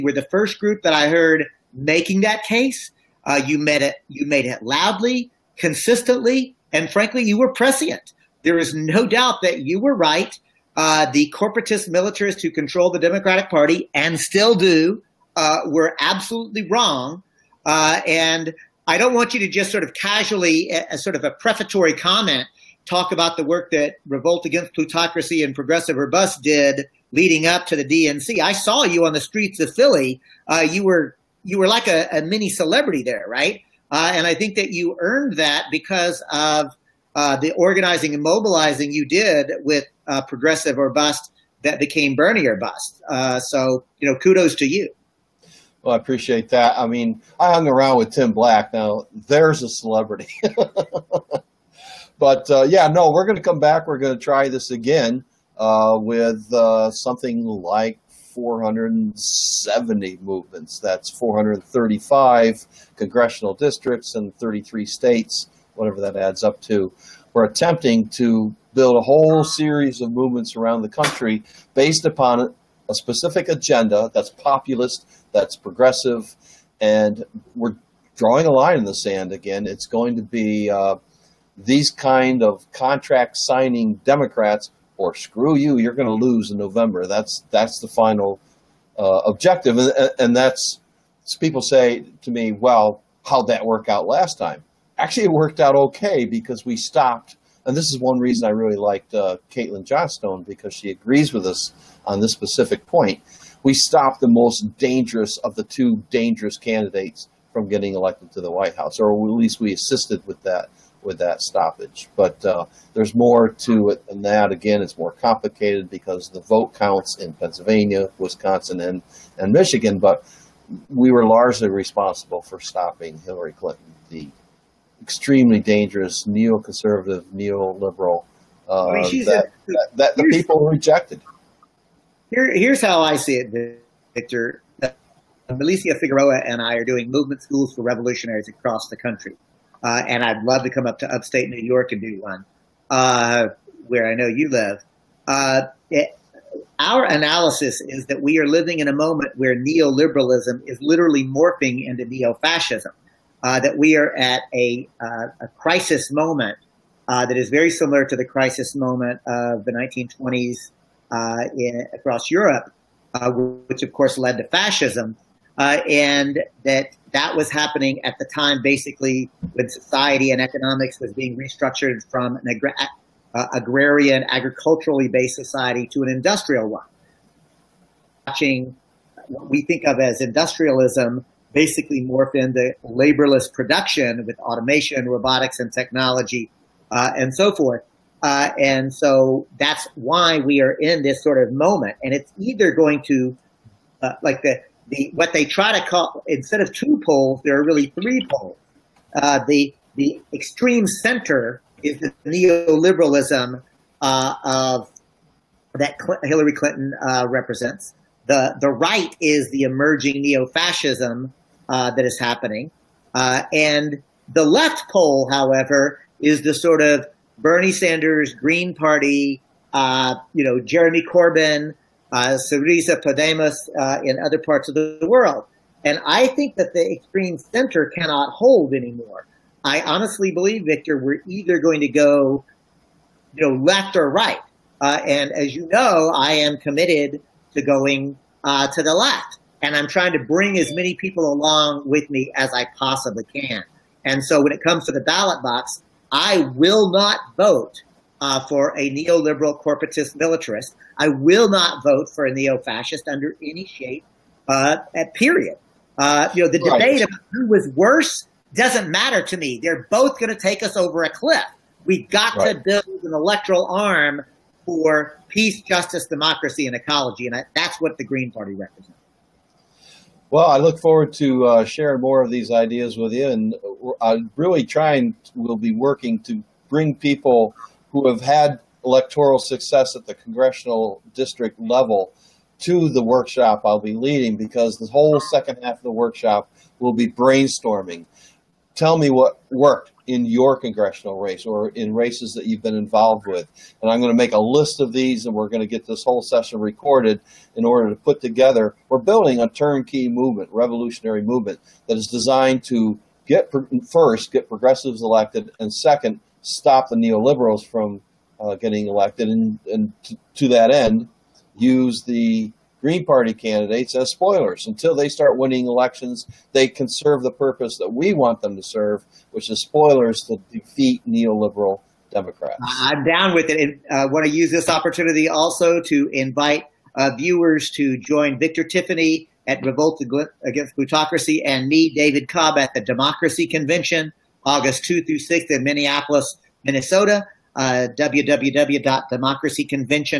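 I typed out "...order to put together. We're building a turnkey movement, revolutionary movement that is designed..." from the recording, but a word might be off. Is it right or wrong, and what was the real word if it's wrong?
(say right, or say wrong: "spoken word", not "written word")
right.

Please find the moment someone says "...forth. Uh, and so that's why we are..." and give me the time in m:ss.
3:07.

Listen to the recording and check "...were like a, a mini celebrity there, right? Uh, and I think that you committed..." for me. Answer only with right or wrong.
wrong.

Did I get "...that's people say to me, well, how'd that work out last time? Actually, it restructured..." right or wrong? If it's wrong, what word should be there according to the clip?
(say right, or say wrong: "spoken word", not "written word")
wrong: "worked", not "restructured".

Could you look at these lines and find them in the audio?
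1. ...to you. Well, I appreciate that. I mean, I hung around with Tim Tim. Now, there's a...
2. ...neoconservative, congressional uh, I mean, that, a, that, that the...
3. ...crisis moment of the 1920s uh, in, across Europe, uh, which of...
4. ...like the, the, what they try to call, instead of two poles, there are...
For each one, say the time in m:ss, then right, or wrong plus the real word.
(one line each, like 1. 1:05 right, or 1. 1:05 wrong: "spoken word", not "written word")
1. 0:44 wrong: "Black", not "Tim"
2. 2:06 wrong: "neoliberal", not "congressional"
3. 2:38 right
4. 3:14 right.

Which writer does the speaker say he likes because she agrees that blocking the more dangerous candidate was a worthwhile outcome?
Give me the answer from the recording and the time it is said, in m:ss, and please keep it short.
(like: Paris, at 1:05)
Caitlin Johnstone, at 1:39.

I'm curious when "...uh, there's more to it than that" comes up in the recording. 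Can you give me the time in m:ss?
1:52.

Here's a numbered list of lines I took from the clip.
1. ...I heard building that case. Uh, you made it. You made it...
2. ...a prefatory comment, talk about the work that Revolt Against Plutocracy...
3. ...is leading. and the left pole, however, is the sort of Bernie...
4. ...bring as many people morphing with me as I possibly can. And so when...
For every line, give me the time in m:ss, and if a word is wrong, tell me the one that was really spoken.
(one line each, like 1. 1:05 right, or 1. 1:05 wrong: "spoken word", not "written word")
1. 0:00 wrong: "making", not "building"
2. 0:21 right
3. 3:32 wrong: "happening", not "leading"
4. 4:00 wrong: "along", not "morphing".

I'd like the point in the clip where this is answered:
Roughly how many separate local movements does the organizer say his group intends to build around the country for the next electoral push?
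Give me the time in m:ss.
0:58.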